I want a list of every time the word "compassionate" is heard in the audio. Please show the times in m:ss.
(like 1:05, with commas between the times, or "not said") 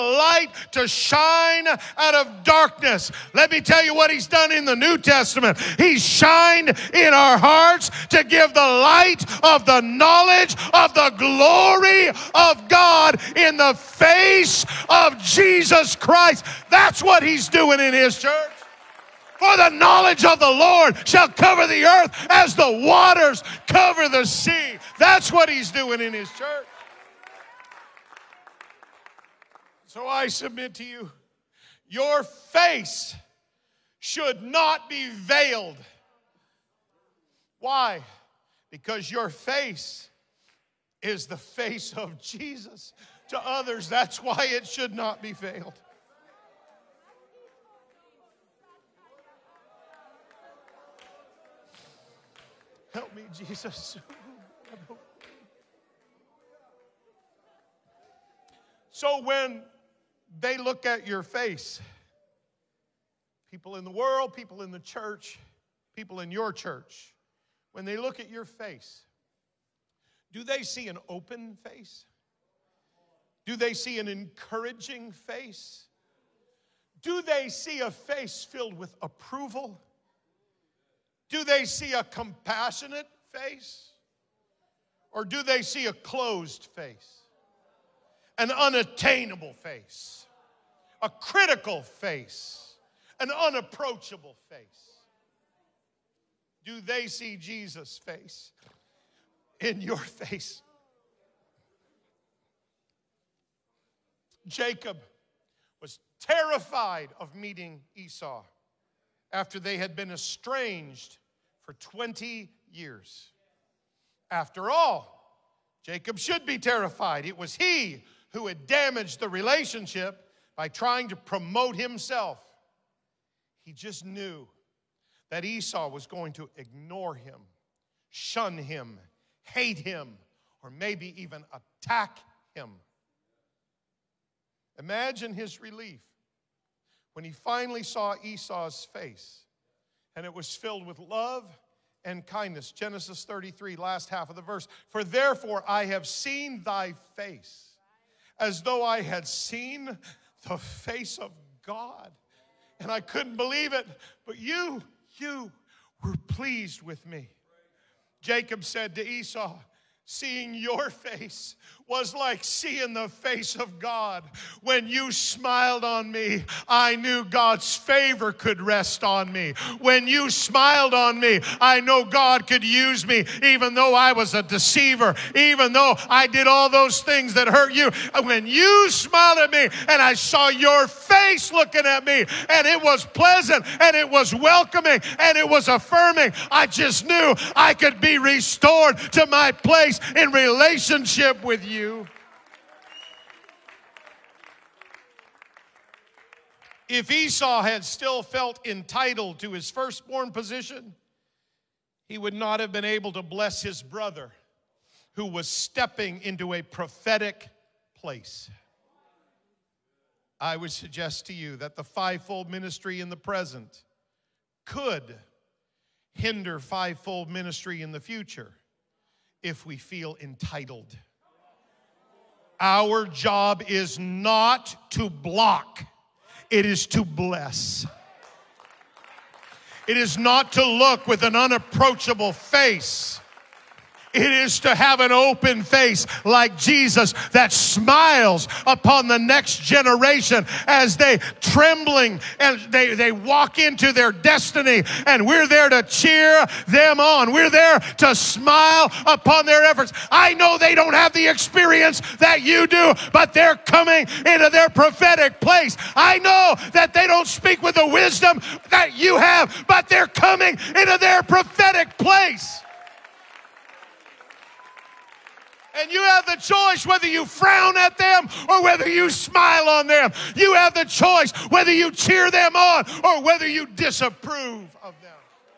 1:22.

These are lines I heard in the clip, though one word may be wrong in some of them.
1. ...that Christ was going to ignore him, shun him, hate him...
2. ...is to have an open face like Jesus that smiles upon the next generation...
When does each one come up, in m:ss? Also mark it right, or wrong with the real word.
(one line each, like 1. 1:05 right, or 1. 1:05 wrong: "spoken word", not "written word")
1. 2:05 wrong: "Esau", not "Christ"
2. 3:54 right.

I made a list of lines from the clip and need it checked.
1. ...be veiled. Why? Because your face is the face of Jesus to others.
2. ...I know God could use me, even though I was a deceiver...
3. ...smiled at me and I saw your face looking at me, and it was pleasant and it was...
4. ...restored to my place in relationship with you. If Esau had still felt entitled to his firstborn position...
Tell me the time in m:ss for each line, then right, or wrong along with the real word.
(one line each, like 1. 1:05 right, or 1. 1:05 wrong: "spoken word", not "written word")
1. 0:34 right
2. 2:51 right
3. 2:58 right
4. 3:08 right.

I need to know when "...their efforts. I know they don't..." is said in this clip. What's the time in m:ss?
4:09.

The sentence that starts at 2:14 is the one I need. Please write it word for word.
Imagine his relief when he finally saw Esau's face and it was filled with love and kindness.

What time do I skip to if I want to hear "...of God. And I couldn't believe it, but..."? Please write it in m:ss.
2:31.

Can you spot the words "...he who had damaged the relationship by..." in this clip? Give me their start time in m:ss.
1:57.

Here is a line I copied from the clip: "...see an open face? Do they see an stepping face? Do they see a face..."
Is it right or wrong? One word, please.
wrong.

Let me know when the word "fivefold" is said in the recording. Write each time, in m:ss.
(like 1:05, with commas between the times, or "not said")
3:31, 3:36.